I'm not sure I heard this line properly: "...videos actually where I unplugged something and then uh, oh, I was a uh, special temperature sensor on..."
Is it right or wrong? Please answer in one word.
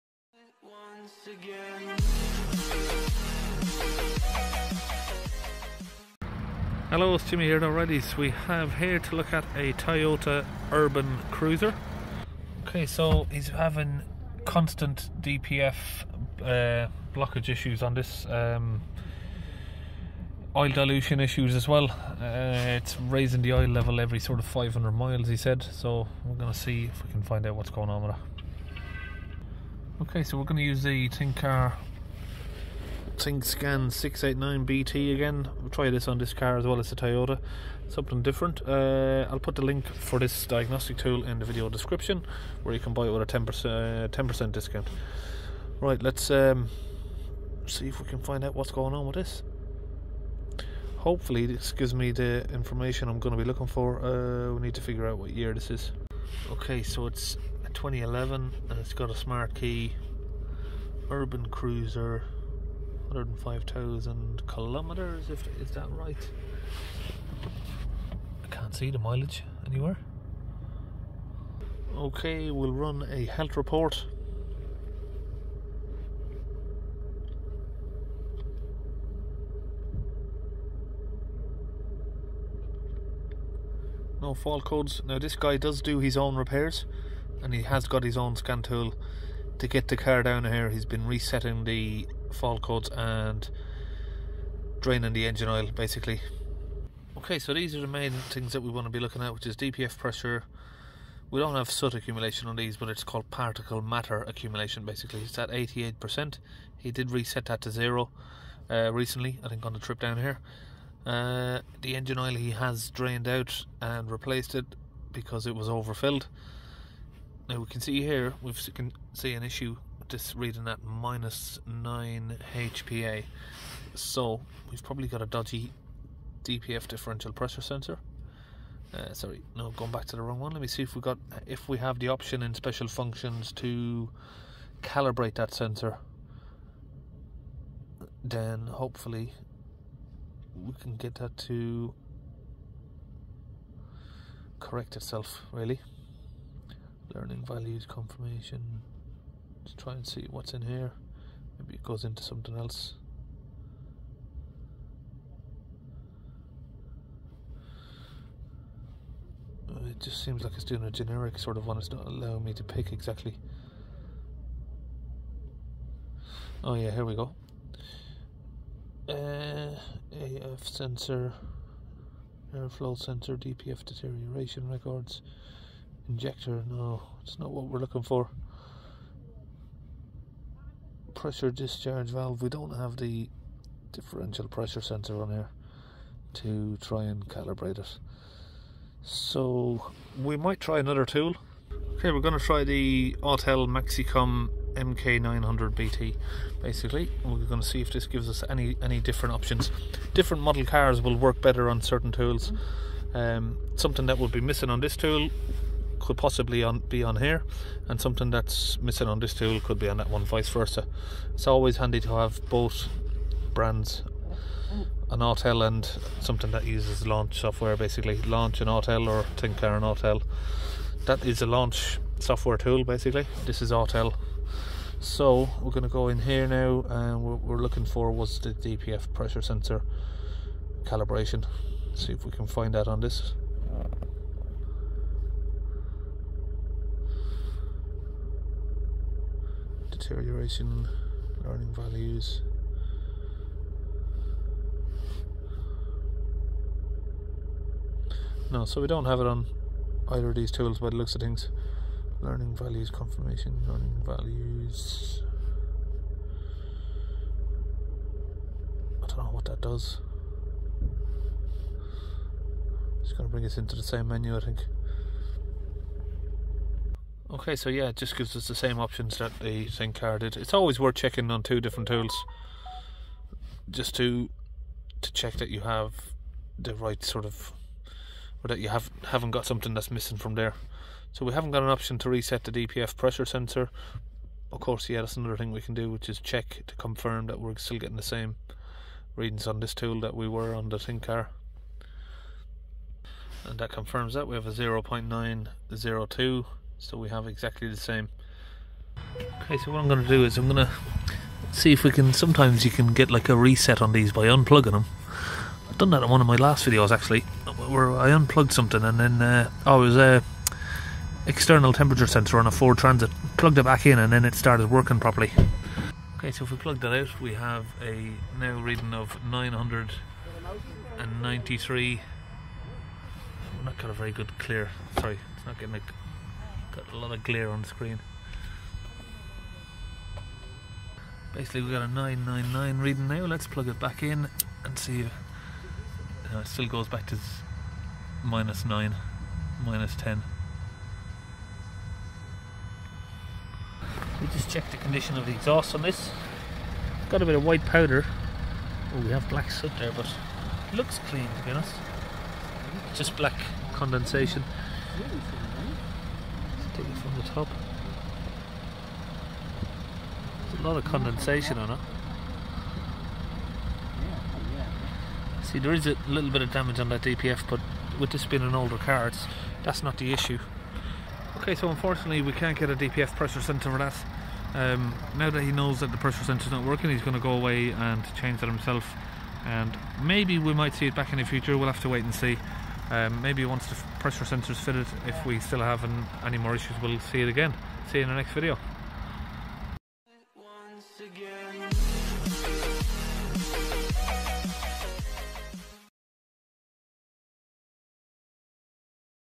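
wrong.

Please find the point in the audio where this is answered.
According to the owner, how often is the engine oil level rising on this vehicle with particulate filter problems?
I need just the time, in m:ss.
0:23.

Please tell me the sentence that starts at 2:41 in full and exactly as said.
It's not allowing me to pick exactly.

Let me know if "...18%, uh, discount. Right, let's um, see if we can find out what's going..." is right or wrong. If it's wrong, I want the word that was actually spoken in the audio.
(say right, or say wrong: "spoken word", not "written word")
wrong: "10", not "18".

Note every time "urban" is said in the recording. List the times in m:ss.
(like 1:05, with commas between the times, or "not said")
0:10, 1:01.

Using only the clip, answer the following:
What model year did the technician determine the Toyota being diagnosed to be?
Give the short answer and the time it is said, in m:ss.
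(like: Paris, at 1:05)
2011, at 0:57.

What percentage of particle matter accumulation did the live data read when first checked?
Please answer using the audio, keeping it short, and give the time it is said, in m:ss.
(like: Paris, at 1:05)
88%, at 1:45.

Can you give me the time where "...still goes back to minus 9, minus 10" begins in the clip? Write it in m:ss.
5:36.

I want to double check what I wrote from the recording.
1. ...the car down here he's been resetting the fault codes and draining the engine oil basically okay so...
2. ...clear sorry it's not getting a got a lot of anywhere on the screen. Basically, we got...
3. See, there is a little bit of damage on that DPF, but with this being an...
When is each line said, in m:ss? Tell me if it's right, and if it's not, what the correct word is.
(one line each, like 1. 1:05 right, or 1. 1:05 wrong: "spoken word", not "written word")
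1. 1:29 right
2. 5:24 wrong: "glare", not "anywhere"
3. 6:05 right.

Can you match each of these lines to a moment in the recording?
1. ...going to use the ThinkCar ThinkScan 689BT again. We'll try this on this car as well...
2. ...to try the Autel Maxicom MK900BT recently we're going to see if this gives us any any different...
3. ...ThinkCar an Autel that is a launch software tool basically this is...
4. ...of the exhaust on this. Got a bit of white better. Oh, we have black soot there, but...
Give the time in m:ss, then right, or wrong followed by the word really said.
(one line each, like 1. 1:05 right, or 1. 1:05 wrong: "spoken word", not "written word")
1. 0:30 right
2. 3:12 wrong: "basically", not "recently"
3. 3:39 right
4. 5:45 wrong: "powder", not "better".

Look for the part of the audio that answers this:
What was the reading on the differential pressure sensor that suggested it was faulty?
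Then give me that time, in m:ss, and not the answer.
2:00.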